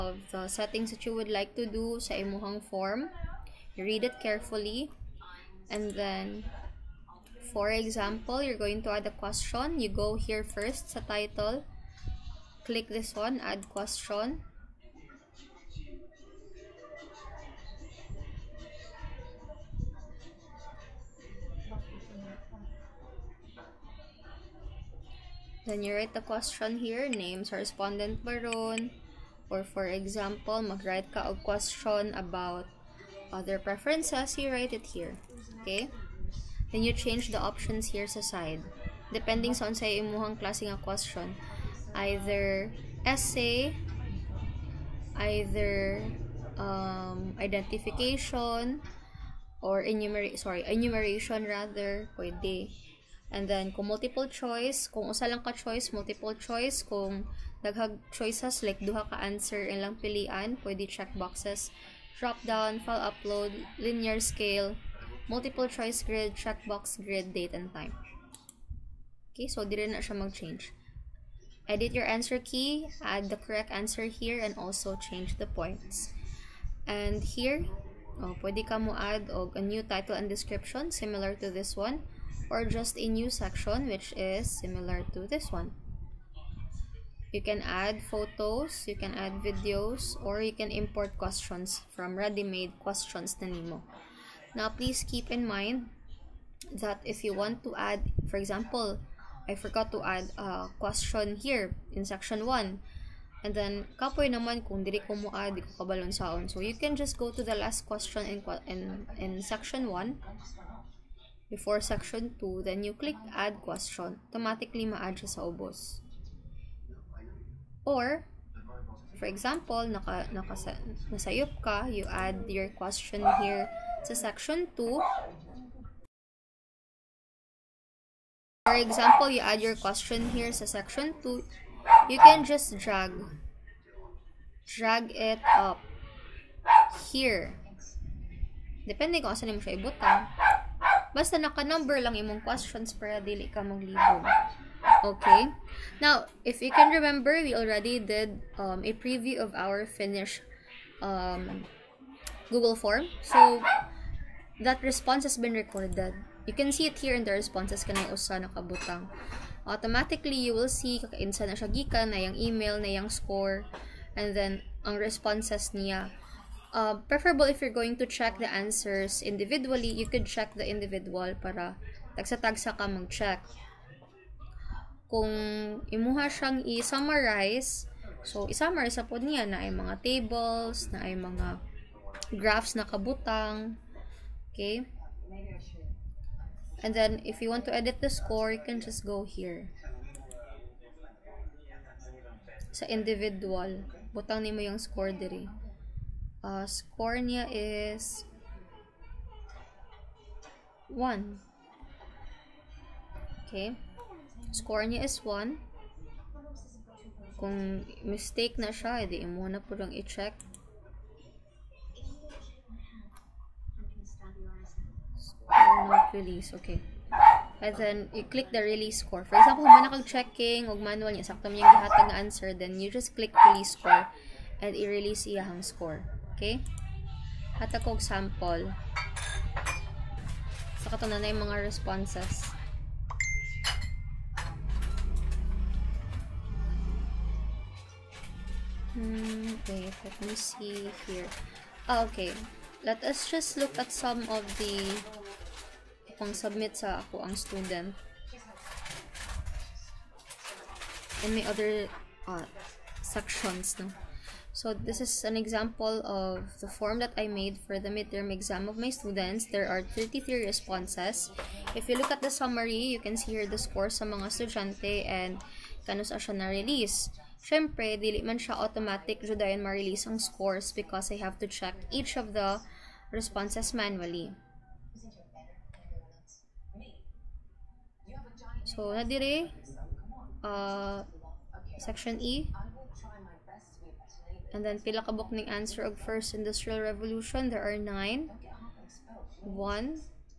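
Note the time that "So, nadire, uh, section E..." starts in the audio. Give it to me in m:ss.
4:38.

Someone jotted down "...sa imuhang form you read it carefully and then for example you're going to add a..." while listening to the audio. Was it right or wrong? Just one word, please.
right.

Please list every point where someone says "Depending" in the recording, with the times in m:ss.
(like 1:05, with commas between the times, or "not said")
0:39, 2:18.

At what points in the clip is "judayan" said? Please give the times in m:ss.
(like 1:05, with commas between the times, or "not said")
4:29.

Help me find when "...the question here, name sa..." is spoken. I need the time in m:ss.
0:26.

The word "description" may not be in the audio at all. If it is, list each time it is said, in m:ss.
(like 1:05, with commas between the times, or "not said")
1:20.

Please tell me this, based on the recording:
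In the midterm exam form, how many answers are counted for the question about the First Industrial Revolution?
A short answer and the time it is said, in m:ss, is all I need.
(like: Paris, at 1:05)
9, at 4:47.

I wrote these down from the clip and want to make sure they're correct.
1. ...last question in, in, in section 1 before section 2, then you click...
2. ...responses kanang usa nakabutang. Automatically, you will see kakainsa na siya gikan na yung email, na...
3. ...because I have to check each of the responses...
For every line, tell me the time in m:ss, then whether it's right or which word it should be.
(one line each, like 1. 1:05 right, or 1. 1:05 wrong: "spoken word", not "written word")
1. 1:47 right
2. 2:37 right
3. 4:30 right.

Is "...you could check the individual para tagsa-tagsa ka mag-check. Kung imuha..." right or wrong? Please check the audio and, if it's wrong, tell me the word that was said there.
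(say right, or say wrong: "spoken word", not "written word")
right.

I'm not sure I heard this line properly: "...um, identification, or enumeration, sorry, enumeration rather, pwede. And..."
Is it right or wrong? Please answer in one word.
right.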